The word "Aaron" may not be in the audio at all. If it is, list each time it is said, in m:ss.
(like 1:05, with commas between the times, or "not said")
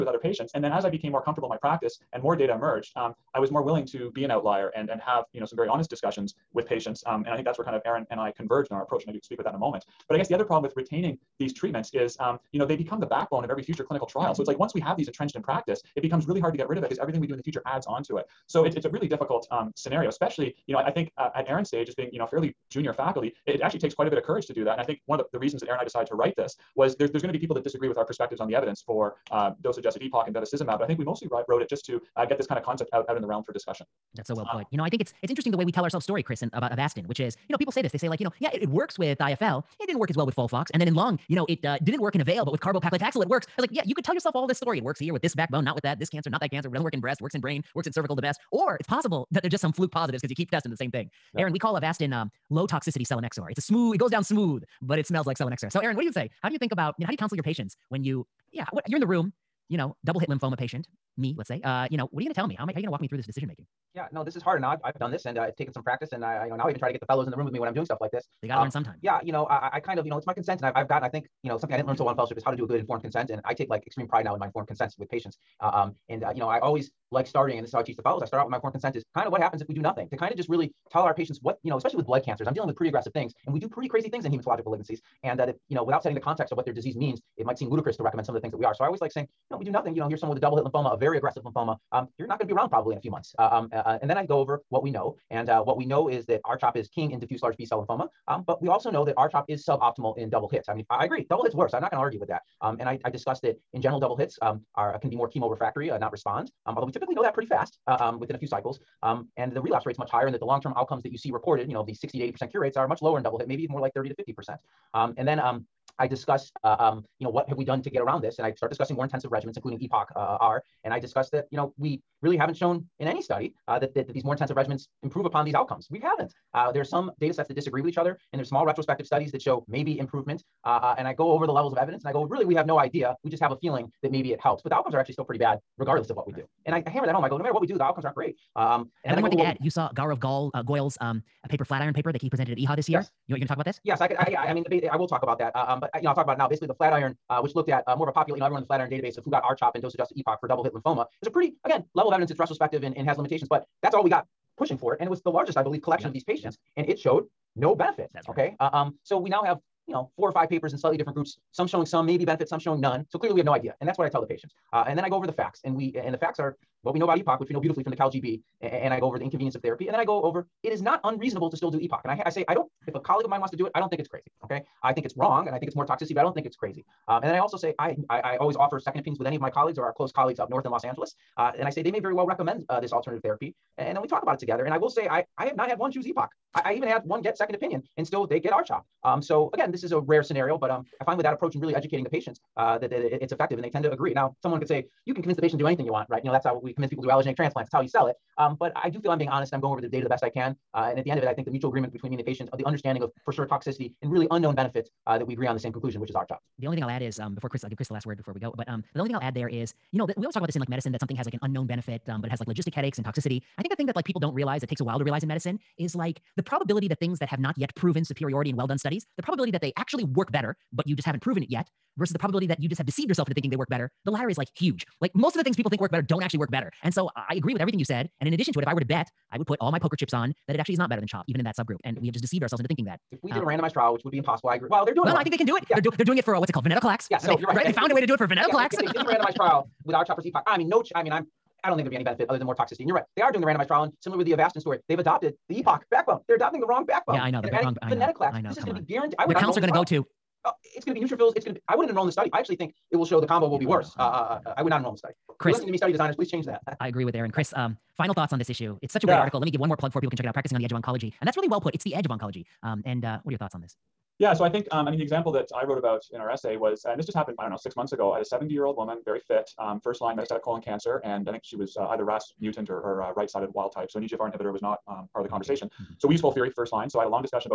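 0:07, 0:21, 0:25, 0:51, 0:55, 4:17.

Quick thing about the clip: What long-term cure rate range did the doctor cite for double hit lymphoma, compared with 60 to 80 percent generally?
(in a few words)
30 to 50 percent.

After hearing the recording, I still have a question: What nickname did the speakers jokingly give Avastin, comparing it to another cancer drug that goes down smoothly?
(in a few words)
low toxicity selinexor.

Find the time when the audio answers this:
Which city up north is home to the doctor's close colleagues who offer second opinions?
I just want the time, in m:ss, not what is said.
3:00.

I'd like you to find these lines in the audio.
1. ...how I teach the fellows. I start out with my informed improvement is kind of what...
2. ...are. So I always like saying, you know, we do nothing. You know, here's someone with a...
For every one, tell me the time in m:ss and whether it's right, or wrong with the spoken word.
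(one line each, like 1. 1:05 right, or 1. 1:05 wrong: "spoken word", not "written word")
1. 1:17 wrong: "consent", not "improvement"
2. 1:28 right.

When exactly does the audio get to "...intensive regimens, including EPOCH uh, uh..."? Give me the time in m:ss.
1:59.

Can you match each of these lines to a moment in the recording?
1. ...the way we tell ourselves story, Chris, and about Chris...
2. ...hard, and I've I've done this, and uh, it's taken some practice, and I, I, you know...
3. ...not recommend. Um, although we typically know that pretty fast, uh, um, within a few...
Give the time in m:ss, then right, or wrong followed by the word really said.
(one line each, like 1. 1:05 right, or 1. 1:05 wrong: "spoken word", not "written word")
1. 0:35 wrong: "Avastin", not "Chris"
2. 1:04 right
3. 1:45 wrong: "respond", not "recommend".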